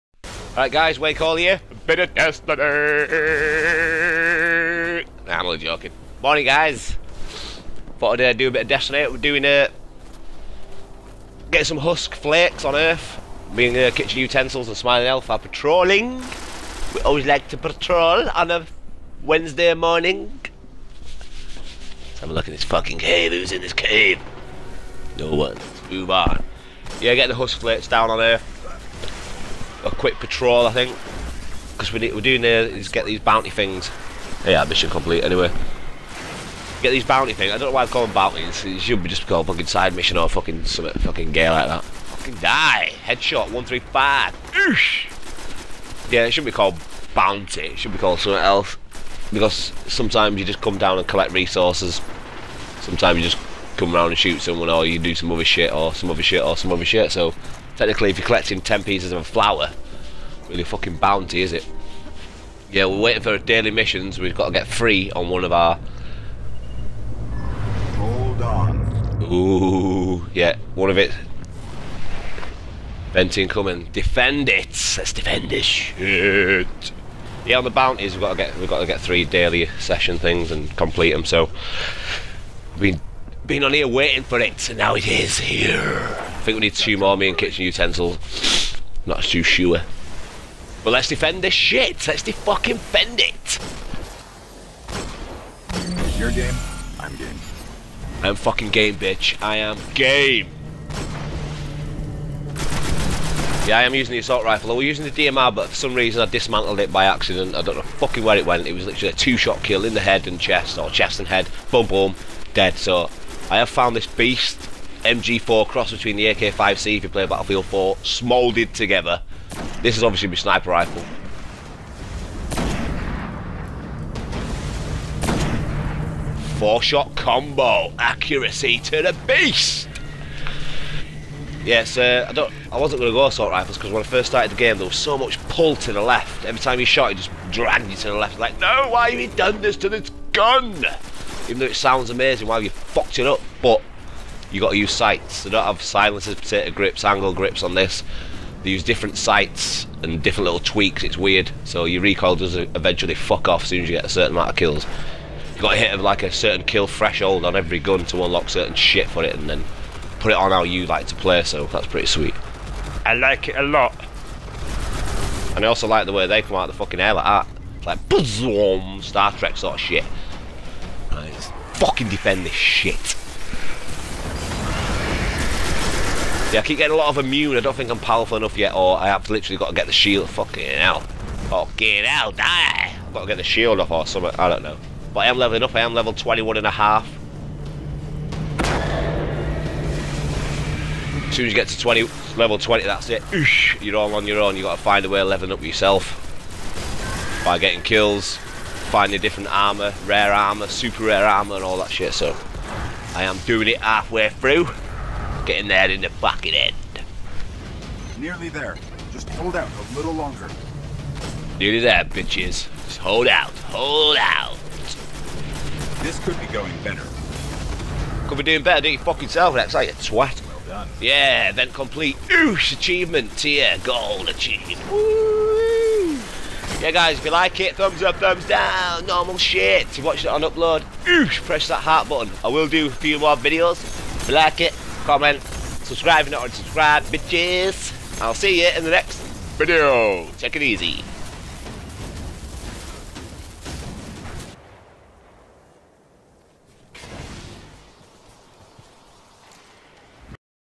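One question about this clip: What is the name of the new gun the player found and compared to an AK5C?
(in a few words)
MG4.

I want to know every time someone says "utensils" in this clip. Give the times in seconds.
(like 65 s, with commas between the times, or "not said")
14 s, 87 s.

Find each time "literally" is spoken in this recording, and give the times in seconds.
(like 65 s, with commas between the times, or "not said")
108 s, 179 s.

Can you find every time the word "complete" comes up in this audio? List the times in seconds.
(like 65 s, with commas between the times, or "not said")
34 s, 80 s, 221 s.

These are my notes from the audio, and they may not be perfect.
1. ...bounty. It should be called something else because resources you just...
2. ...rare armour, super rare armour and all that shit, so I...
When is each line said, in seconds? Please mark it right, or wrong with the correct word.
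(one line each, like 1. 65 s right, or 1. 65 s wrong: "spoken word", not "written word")
1. 47 s wrong: "sometimes", not "resources"
2. 200 s right.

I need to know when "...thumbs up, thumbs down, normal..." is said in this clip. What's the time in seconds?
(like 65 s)
227 s.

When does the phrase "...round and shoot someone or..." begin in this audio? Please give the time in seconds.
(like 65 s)
53 s.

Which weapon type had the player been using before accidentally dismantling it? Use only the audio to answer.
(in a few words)
DMR.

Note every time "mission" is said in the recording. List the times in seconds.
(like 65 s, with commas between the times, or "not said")
34 s, 39 s, 63 s.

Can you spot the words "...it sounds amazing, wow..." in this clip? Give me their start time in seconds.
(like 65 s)
141 s.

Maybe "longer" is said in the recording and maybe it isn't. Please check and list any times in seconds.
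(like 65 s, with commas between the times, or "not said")
210 s.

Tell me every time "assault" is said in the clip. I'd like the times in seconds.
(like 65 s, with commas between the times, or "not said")
104 s, 133 s.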